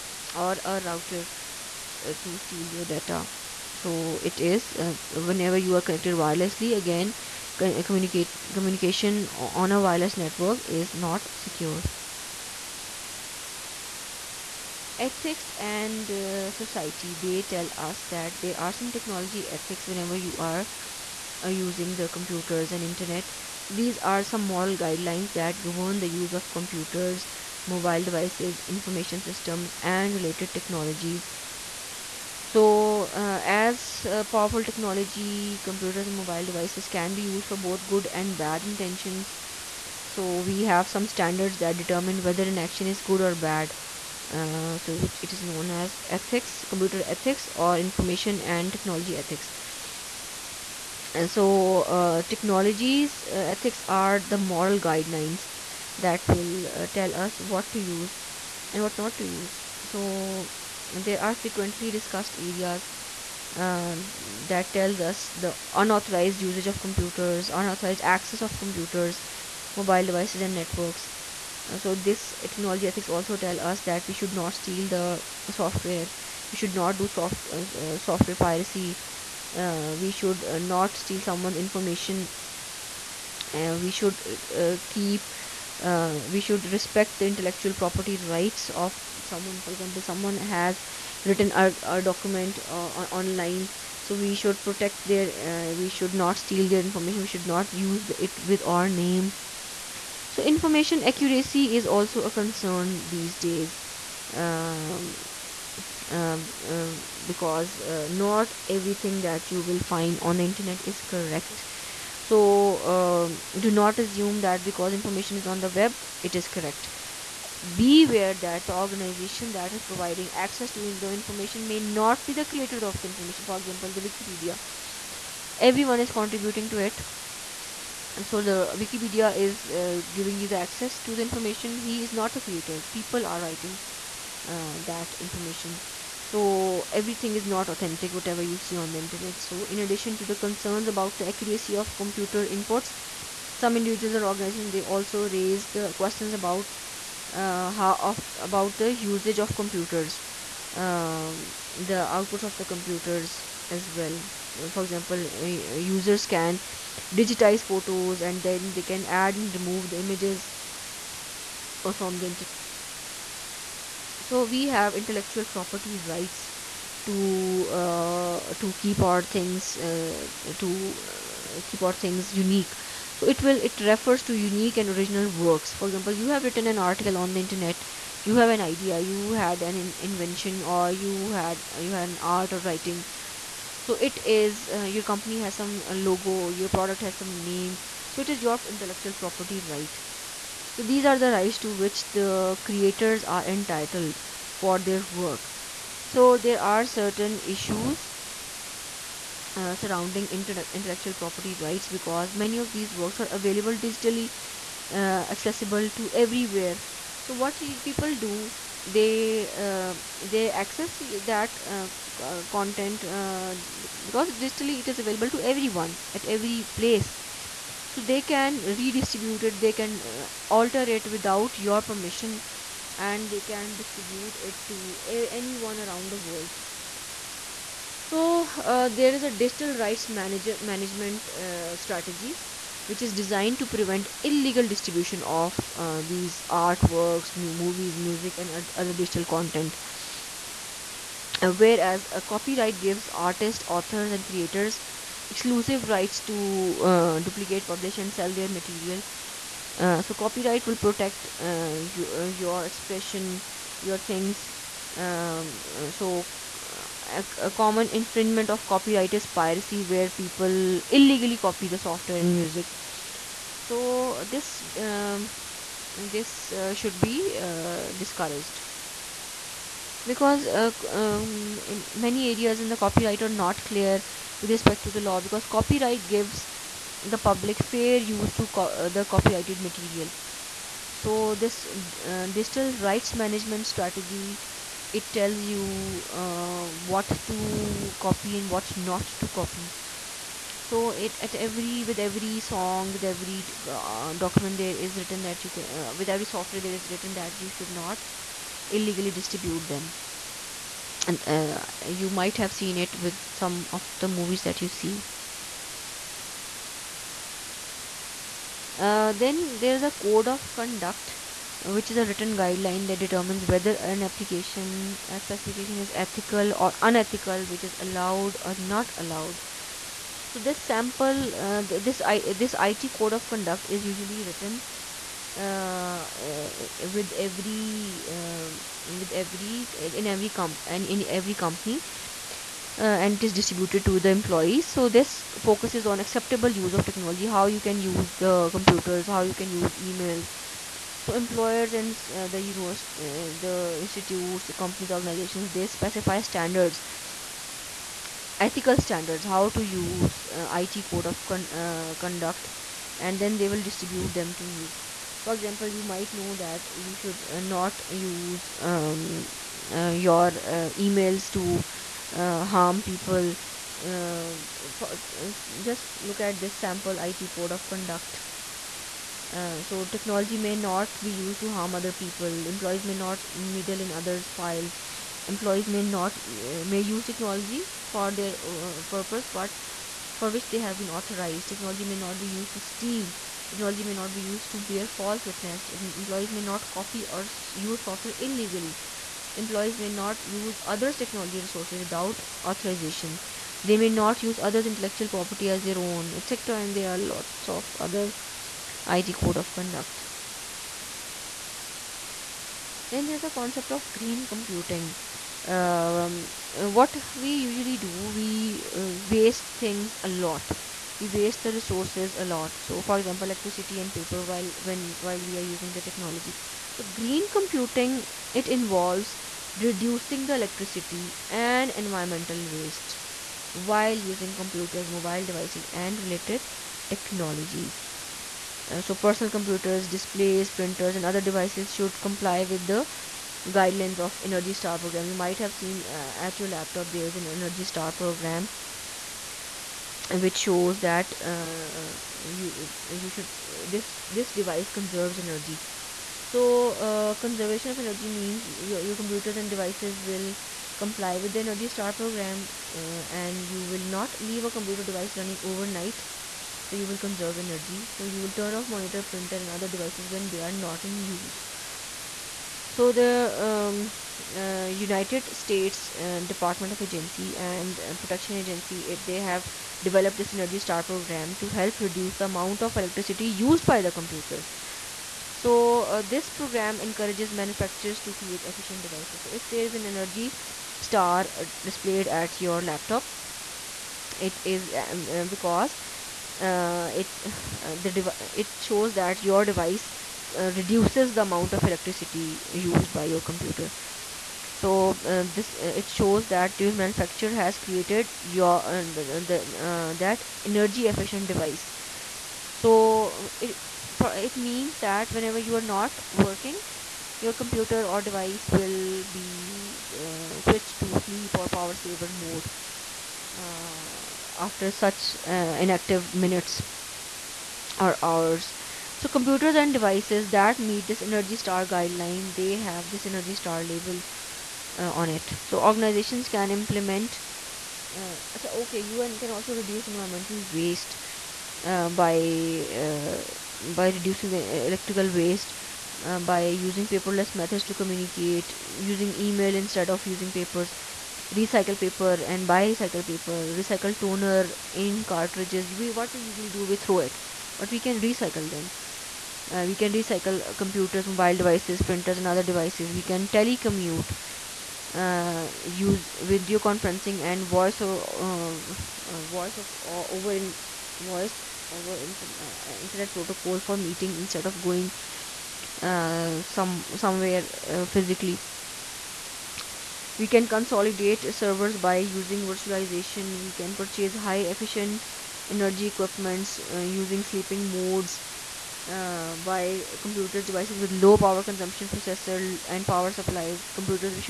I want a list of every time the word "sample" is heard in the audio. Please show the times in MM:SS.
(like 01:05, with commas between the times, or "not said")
05:20, 06:06.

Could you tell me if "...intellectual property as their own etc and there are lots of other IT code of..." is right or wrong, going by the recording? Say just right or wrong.
right.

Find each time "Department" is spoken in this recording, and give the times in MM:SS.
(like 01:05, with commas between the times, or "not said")
07:46.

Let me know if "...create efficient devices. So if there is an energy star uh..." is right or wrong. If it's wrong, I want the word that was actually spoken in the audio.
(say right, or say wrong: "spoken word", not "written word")
right.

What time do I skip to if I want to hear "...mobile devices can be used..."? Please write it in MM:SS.
00:36.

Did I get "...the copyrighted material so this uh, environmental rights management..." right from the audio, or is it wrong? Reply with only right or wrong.
wrong.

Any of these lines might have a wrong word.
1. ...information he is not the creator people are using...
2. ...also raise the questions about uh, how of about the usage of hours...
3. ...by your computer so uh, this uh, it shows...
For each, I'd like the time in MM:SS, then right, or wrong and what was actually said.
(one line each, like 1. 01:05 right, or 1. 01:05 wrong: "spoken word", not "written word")
1. 02:11 wrong: "writing", not "using"
2. 02:24 wrong: "computers", not "hours"
3. 08:12 right.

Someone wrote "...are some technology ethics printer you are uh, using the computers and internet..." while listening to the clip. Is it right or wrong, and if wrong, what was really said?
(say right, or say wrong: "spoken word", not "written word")
wrong: "whenever", not "printer".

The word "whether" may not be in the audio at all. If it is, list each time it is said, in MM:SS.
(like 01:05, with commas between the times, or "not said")
00:42, 05:13.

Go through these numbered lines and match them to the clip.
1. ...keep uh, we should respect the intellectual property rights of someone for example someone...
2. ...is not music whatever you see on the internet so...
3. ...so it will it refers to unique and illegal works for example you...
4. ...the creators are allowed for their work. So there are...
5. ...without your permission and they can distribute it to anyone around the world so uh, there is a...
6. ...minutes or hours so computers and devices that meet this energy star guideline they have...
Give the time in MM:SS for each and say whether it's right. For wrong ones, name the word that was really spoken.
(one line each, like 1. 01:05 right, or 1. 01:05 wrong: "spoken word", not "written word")
1. 01:24 right
2. 02:17 wrong: "authentic", not "music"
3. 02:53 wrong: "original", not "illegal"
4. 03:12 wrong: "entitled", not "allowed"
5. 03:41 right
6. 08:36 right.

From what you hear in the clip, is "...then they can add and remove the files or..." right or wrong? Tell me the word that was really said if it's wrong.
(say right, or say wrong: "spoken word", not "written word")
wrong: "images", not "files".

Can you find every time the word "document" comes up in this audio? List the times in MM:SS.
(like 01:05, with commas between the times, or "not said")
01:32, 04:54.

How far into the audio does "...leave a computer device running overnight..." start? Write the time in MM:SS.
07:34.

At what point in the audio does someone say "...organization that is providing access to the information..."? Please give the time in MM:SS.
01:58.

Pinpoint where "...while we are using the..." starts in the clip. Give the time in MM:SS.
06:55.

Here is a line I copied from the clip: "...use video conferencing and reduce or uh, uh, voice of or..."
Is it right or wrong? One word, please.
wrong.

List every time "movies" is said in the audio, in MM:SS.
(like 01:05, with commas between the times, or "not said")
03:57, 05:04.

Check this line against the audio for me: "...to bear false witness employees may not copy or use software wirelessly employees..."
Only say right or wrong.
wrong.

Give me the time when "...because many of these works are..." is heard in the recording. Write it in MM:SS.
03:21.